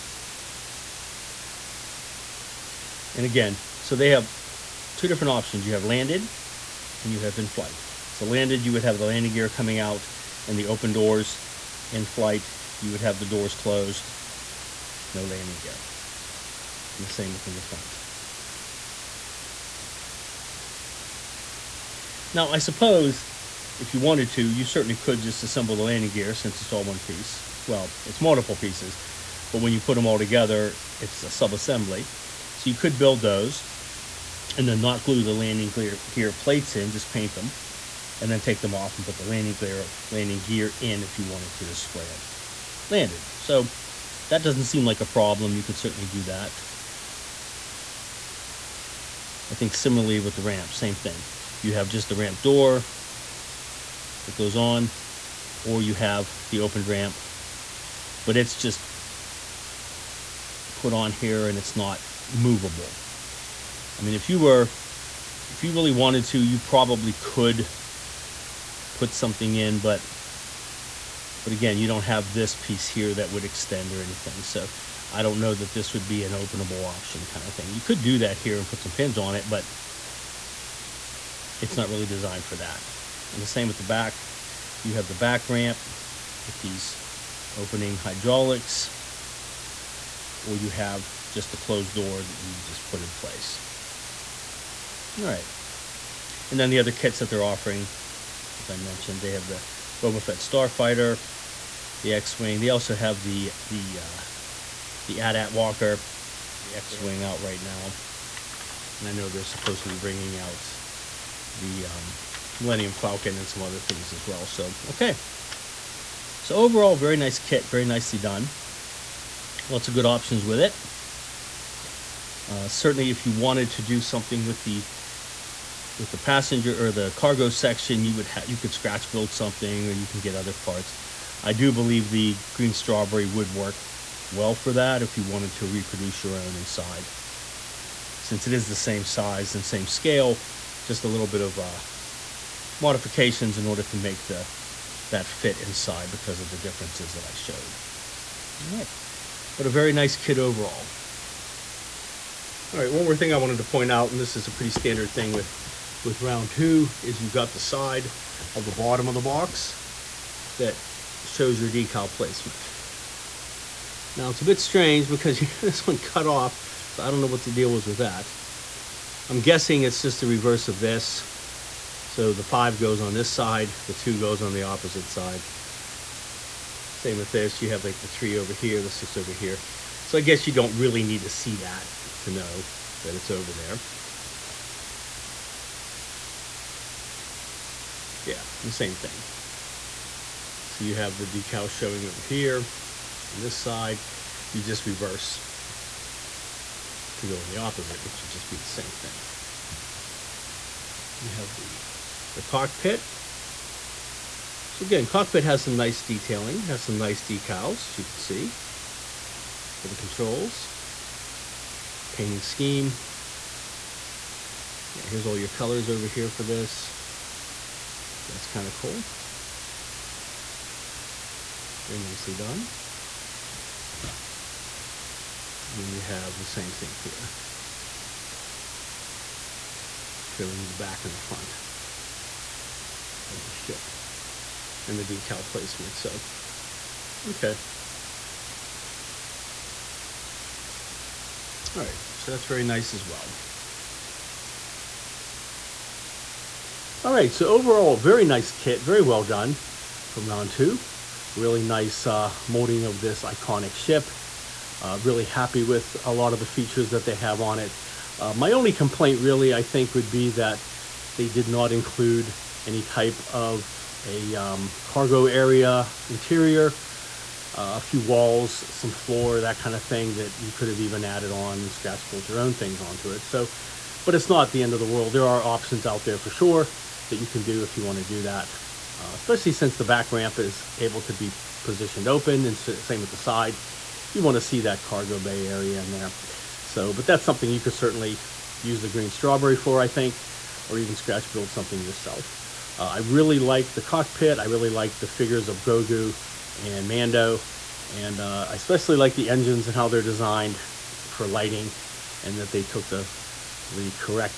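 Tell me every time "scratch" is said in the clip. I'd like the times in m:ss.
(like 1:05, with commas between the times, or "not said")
2:08, 4:31, 4:50.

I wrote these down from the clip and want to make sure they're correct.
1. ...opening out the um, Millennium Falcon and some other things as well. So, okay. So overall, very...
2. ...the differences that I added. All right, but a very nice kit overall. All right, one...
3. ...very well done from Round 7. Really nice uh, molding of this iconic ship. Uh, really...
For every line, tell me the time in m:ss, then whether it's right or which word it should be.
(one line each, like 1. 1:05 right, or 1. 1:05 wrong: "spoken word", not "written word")
1. 1:49 wrong: "bringing", not "opening"
2. 2:26 wrong: "showed", not "added"
3. 4:08 wrong: "2", not "7".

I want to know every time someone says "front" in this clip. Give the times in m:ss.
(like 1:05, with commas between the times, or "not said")
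0:17, 3:51.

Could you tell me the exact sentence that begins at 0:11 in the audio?
In flight, you would have the doors closed, no landing gear.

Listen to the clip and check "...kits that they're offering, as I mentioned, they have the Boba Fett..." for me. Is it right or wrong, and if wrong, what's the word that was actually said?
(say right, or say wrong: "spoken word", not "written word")
right.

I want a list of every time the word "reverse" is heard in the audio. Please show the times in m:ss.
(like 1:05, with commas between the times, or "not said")
2:50, 3:14.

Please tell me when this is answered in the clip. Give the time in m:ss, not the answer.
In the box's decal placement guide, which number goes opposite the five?
2:53.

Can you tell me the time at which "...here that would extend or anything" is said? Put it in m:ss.
1:12.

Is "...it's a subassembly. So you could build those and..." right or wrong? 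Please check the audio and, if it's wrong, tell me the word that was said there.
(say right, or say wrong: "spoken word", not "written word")
right.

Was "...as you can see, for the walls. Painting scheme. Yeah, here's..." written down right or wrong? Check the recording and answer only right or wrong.
wrong.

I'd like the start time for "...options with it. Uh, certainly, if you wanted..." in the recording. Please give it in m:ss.
2:00.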